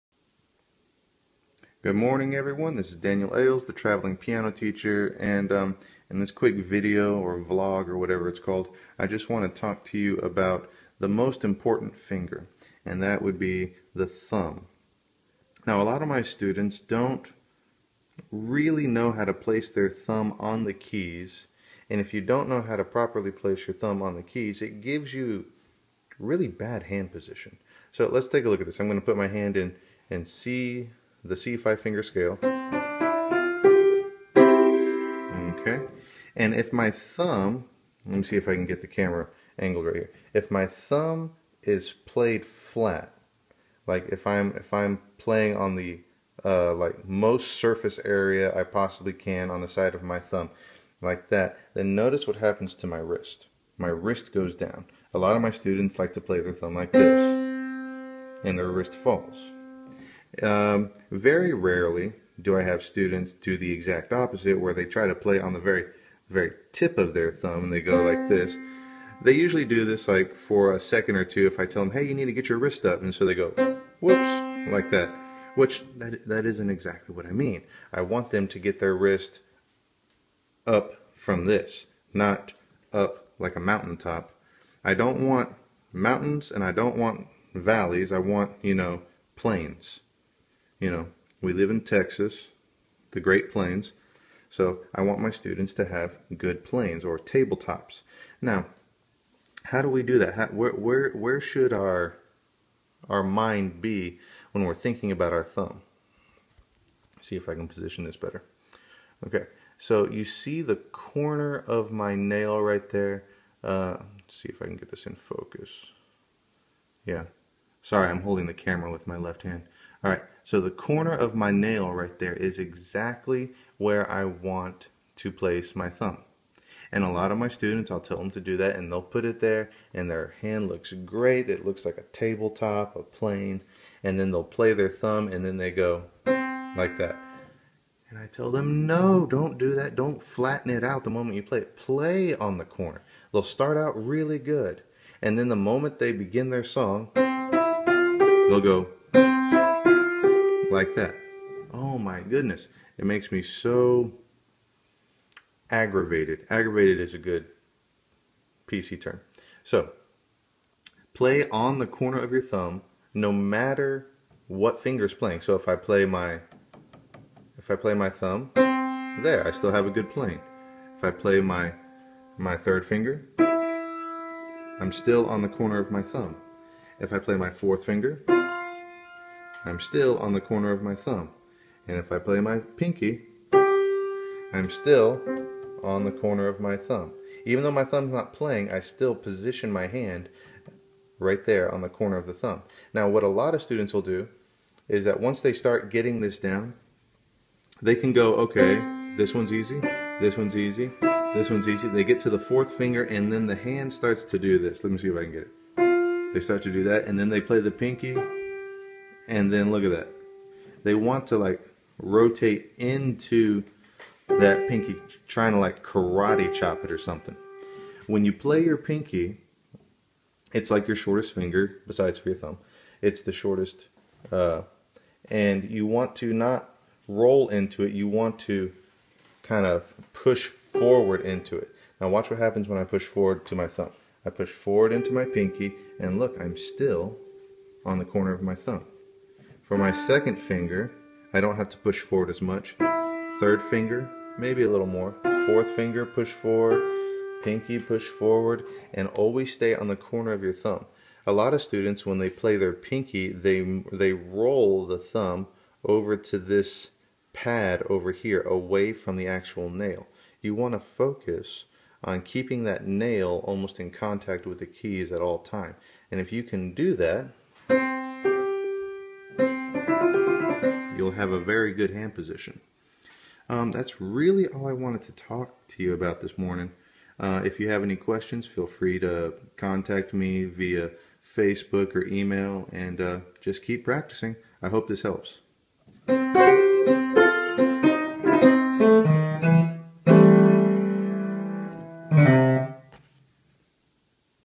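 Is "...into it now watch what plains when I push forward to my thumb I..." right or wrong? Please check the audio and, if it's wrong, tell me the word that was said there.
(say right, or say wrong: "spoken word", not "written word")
wrong: "happens", not "plains".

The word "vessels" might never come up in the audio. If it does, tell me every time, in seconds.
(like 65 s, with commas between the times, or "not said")
not said.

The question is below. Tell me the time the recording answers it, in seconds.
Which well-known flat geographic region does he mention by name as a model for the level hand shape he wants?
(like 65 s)
93 s.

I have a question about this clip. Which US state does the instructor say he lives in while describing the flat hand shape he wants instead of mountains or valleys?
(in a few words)
Texas.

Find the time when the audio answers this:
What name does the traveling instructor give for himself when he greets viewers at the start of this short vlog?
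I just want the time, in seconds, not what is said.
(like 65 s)
2 s.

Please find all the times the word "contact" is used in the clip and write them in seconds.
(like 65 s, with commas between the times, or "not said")
263 s, 279 s.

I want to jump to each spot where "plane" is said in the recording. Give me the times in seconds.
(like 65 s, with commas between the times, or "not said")
96 s, 133 s, 170 s.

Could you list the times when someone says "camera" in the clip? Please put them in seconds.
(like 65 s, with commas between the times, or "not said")
38 s, 118 s.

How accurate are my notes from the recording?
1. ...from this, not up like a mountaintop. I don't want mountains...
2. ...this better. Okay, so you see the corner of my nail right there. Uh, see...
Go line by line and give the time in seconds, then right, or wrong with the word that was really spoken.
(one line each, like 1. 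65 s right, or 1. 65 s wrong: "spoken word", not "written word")
1. 81 s right
2. 108 s right.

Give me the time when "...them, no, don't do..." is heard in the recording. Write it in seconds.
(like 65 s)
138 s.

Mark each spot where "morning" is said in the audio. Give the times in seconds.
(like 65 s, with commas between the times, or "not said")
1 s, 276 s.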